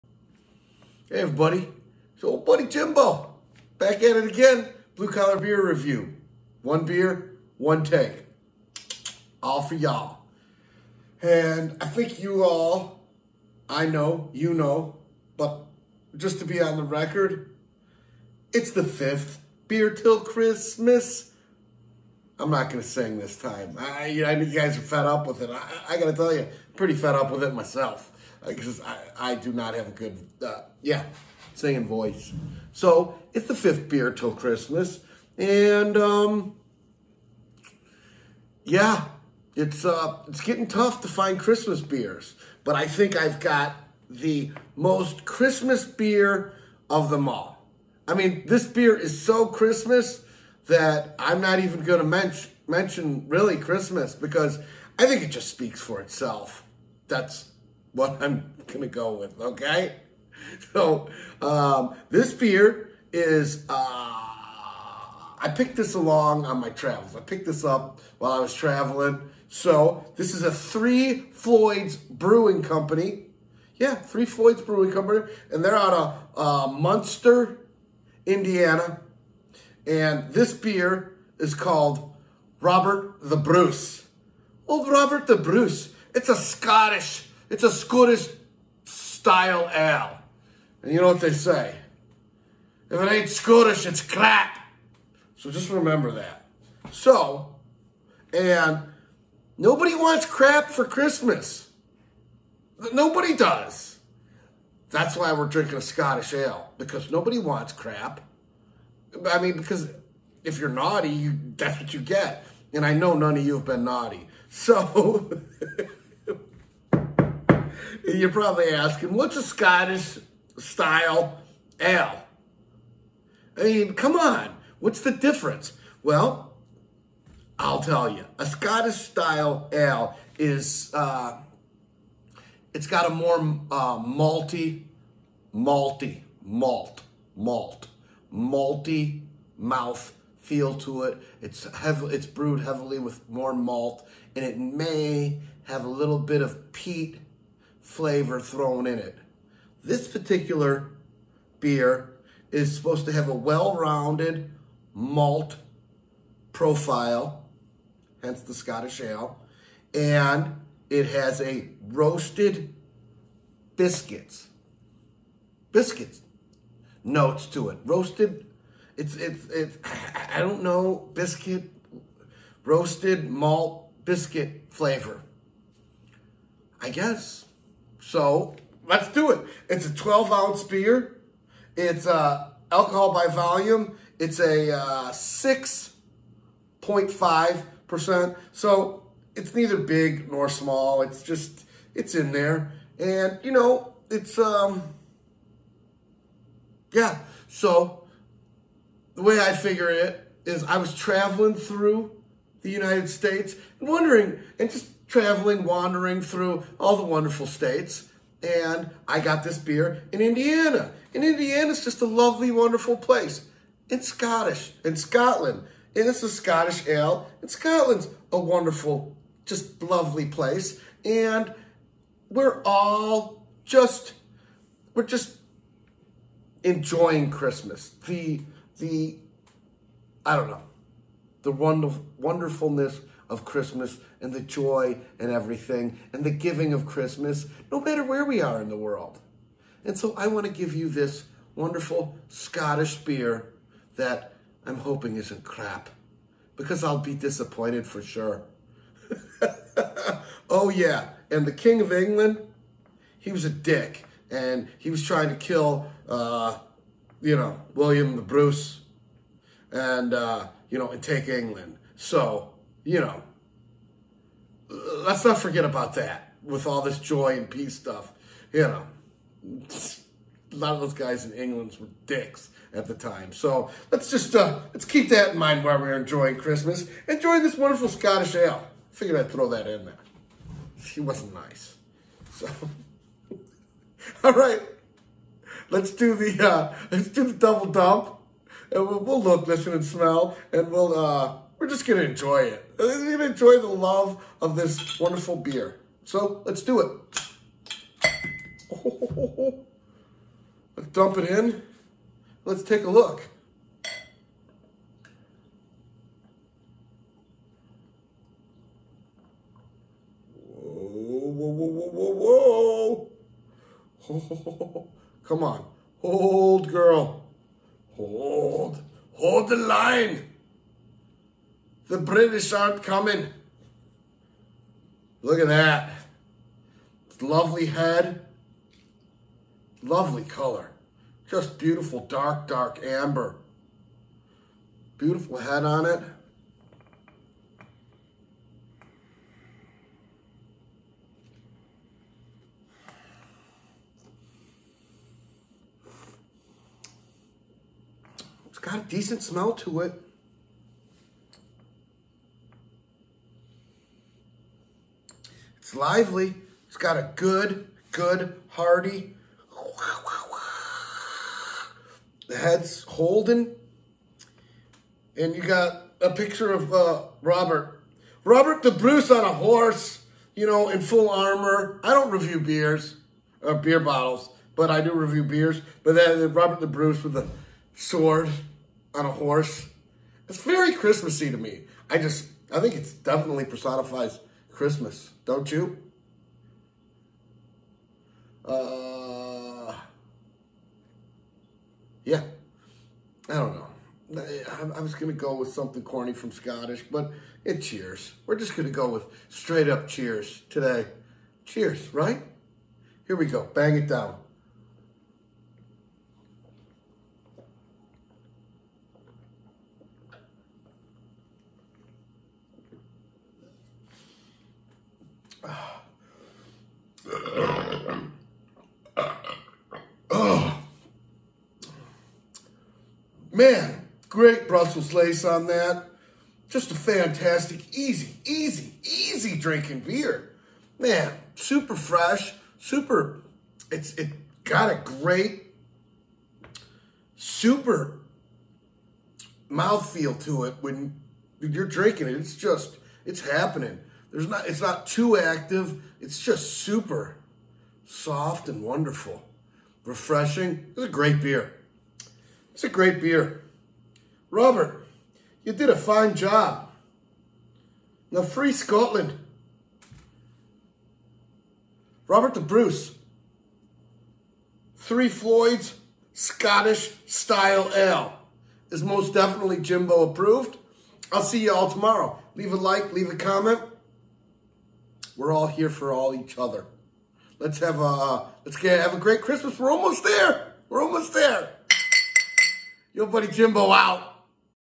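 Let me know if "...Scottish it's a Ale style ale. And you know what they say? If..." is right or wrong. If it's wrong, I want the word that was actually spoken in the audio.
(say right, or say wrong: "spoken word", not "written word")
wrong: "Scottish", not "Ale".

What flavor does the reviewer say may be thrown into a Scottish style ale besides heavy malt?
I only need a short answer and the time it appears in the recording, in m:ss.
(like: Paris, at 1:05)
peat, at 2:26.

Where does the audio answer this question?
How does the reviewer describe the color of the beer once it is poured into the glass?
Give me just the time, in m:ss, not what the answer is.
5:32.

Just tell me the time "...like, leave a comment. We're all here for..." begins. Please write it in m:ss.
7:52.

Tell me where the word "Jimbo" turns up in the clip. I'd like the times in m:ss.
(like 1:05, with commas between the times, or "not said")
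0:02, 7:49, 8:03.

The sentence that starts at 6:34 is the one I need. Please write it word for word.
I, I was going to go with something corny from Scottish, but it cheers.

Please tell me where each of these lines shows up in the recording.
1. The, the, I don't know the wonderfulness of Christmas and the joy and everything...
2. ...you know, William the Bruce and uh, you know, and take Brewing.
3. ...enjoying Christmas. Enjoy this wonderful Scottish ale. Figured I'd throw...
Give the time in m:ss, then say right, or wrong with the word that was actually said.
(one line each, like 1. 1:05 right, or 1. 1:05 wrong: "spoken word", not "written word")
1. 3:48 right
2. 4:17 wrong: "England", not "Brewing"
3. 4:35 right.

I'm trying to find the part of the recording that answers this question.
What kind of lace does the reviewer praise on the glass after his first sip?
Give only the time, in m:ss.
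7:04.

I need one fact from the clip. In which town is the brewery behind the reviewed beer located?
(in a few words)
Munster, Indiana.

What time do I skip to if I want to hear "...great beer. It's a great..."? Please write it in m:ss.
7:30.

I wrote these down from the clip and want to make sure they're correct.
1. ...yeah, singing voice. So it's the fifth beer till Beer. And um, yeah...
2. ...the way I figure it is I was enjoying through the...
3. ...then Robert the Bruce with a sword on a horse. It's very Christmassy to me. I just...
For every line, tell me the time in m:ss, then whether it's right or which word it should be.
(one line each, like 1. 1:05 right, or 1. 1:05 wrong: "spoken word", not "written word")
1. 0:30 wrong: "Christmas", not "Beer"
2. 3:19 wrong: "traveling", not "enjoying"
3. 6:15 right.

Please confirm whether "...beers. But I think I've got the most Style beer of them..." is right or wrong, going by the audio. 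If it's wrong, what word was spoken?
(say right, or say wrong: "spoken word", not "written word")
wrong: "Christmas", not "Style".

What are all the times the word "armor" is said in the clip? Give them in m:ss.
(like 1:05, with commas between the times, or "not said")
6:11.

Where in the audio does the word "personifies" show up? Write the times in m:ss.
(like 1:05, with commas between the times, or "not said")
6:23.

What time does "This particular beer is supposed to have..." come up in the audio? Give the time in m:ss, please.
2:29.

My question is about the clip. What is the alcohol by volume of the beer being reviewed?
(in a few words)
6.5%.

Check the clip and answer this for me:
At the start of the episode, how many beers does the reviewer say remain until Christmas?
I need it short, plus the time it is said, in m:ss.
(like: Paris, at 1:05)
5, at 0:18.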